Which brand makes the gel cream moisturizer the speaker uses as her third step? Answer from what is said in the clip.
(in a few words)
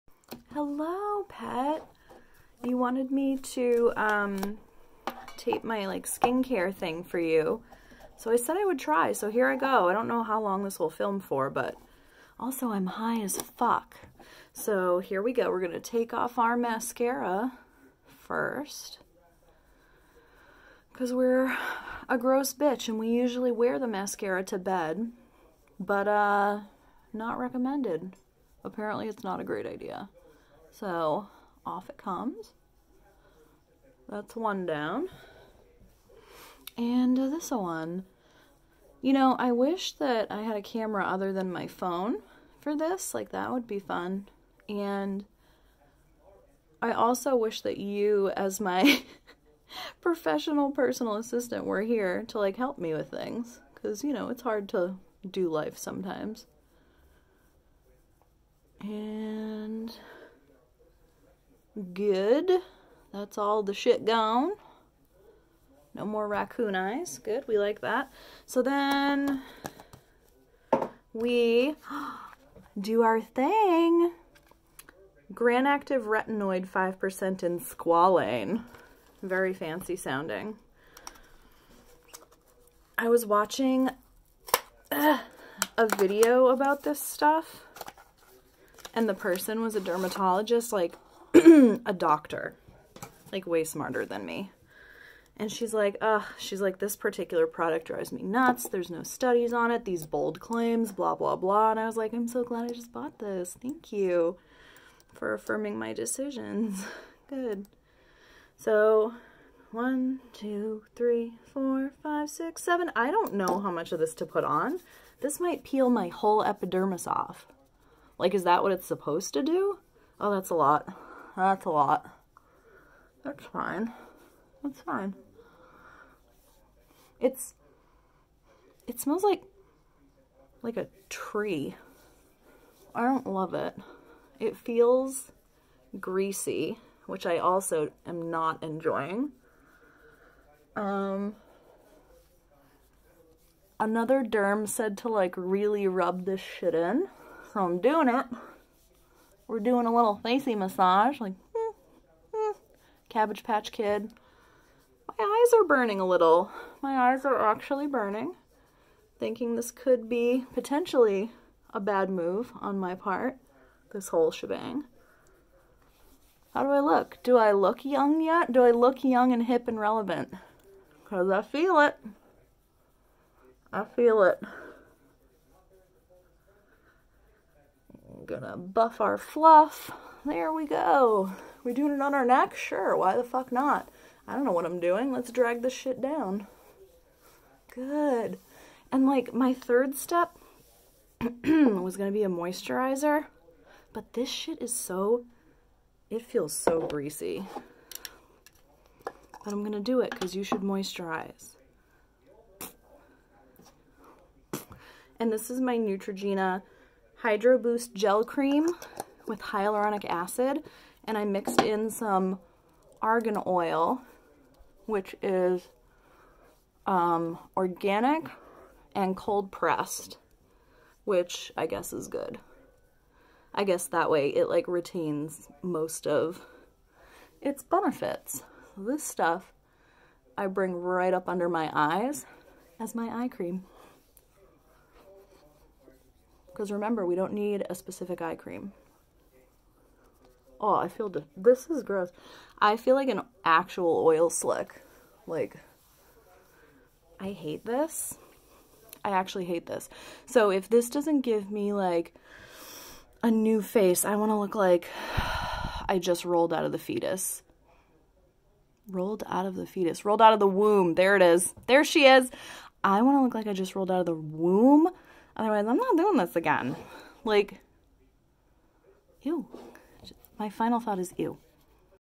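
Neutrogena.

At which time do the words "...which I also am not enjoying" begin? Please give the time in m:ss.
2:17.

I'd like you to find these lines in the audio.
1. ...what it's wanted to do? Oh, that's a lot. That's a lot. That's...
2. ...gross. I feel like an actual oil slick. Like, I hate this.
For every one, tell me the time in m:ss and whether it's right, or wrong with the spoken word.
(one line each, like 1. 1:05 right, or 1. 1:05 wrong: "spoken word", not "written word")
1. 1:58 wrong: "supposed", not "wanted"
2. 4:01 right.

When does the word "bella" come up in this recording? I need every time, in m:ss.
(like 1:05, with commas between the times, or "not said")
not said.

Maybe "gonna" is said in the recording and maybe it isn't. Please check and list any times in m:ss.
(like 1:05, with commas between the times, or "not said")
2:58, 3:11, 3:19.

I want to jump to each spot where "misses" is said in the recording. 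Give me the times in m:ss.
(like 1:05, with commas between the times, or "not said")
not said.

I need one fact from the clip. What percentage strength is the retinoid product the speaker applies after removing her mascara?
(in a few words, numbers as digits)
5%.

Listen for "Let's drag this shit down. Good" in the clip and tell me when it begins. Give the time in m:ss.
3:05.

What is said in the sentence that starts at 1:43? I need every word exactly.
Thank you for affirming my decisions.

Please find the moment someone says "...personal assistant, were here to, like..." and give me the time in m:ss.
0:50.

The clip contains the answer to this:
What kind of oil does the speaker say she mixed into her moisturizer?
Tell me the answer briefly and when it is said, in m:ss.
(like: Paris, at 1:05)
argan oil, at 3:32.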